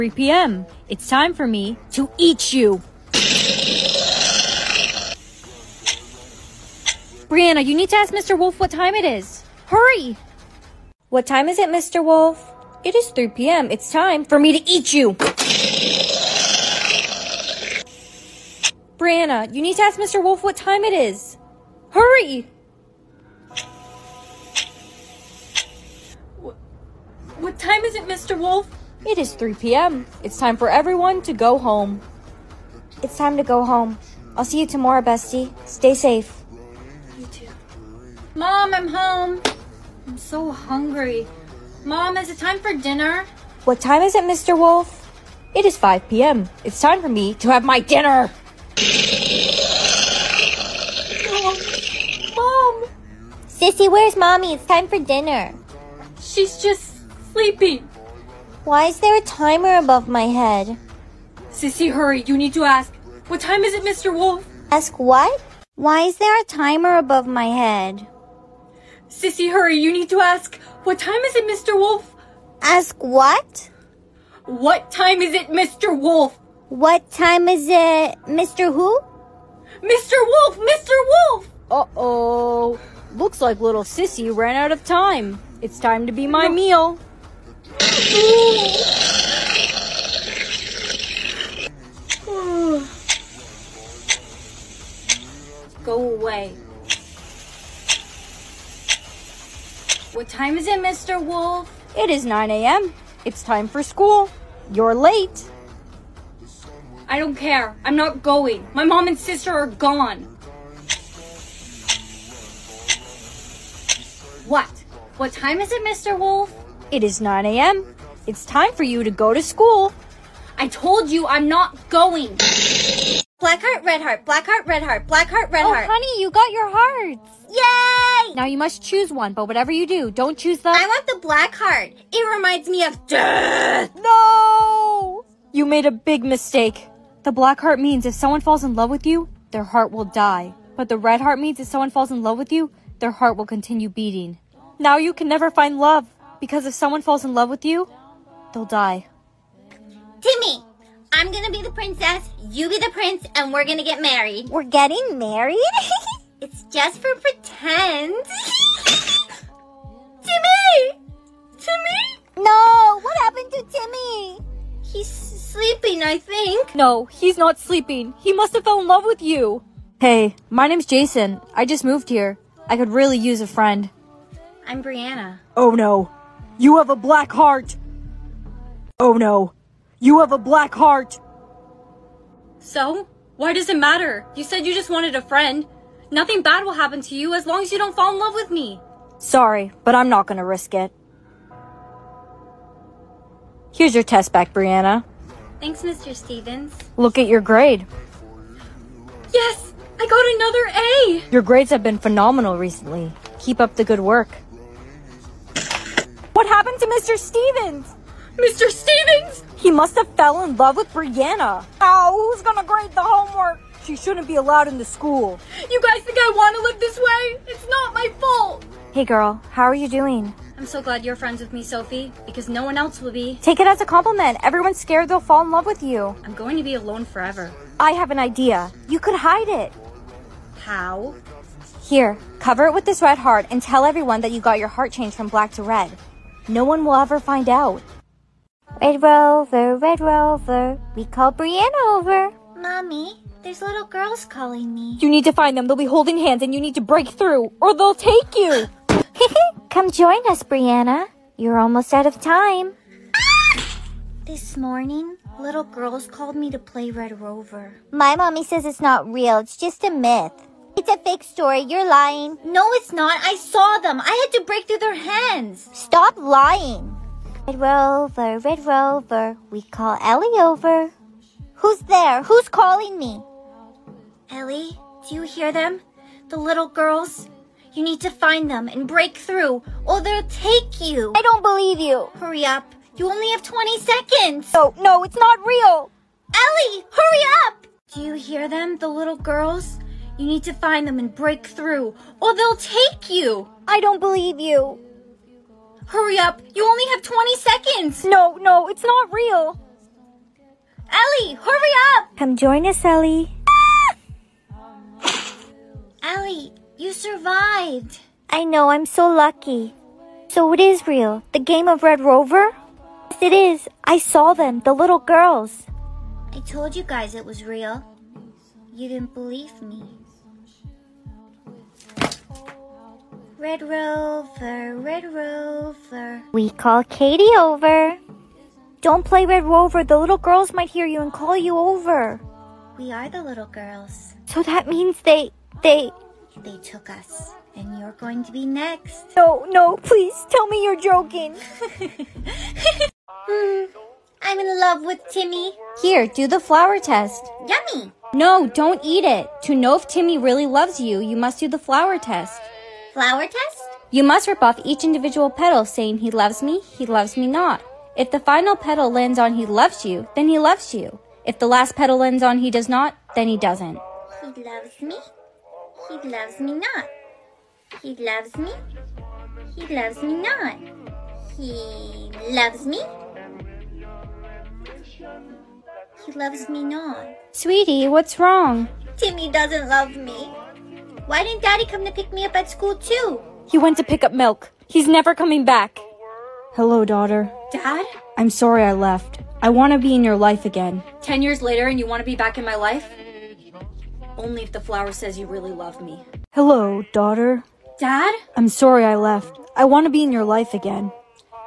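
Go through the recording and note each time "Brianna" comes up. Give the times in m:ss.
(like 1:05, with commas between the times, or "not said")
0:07, 0:18, 2:54, 3:14, 3:30, 4:01, 4:10.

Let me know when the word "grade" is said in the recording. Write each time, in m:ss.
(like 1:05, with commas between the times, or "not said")
3:17, 3:21, 3:32.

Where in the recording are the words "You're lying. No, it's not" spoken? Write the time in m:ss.
4:21.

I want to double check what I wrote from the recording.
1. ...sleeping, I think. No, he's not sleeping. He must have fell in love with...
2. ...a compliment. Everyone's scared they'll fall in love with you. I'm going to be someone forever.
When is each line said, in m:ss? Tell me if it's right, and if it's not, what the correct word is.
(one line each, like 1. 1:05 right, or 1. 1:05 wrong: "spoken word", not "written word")
1. 2:45 right
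2. 3:43 wrong: "alone", not "someone".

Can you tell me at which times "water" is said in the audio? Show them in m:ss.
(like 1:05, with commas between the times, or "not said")
not said.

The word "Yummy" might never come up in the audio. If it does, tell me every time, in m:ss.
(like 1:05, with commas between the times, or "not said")
5:47.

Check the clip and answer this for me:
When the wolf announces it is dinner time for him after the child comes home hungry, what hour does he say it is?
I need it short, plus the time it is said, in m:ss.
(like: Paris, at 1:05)
5 p.m., at 0:45.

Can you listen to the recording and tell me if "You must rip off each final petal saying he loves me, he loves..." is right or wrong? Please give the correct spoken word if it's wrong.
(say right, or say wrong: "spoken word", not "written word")
wrong: "individual", not "final".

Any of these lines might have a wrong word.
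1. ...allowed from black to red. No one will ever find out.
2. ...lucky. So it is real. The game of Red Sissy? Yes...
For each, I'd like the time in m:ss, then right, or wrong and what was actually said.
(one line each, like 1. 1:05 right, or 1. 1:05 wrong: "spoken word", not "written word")
1. 3:54 wrong: "changed", not "allowed"
2. 5:09 wrong: "Rover", not "Sissy".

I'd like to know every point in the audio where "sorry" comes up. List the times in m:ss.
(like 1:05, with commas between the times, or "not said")
3:09, 6:28, 6:38.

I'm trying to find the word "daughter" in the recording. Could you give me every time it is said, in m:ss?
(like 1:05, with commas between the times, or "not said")
6:26, 6:36.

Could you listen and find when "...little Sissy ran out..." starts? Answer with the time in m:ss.
1:23.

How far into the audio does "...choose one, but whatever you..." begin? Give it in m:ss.
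2:08.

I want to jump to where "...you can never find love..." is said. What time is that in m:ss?
2:24.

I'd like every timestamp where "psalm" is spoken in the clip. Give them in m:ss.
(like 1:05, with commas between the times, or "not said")
not said.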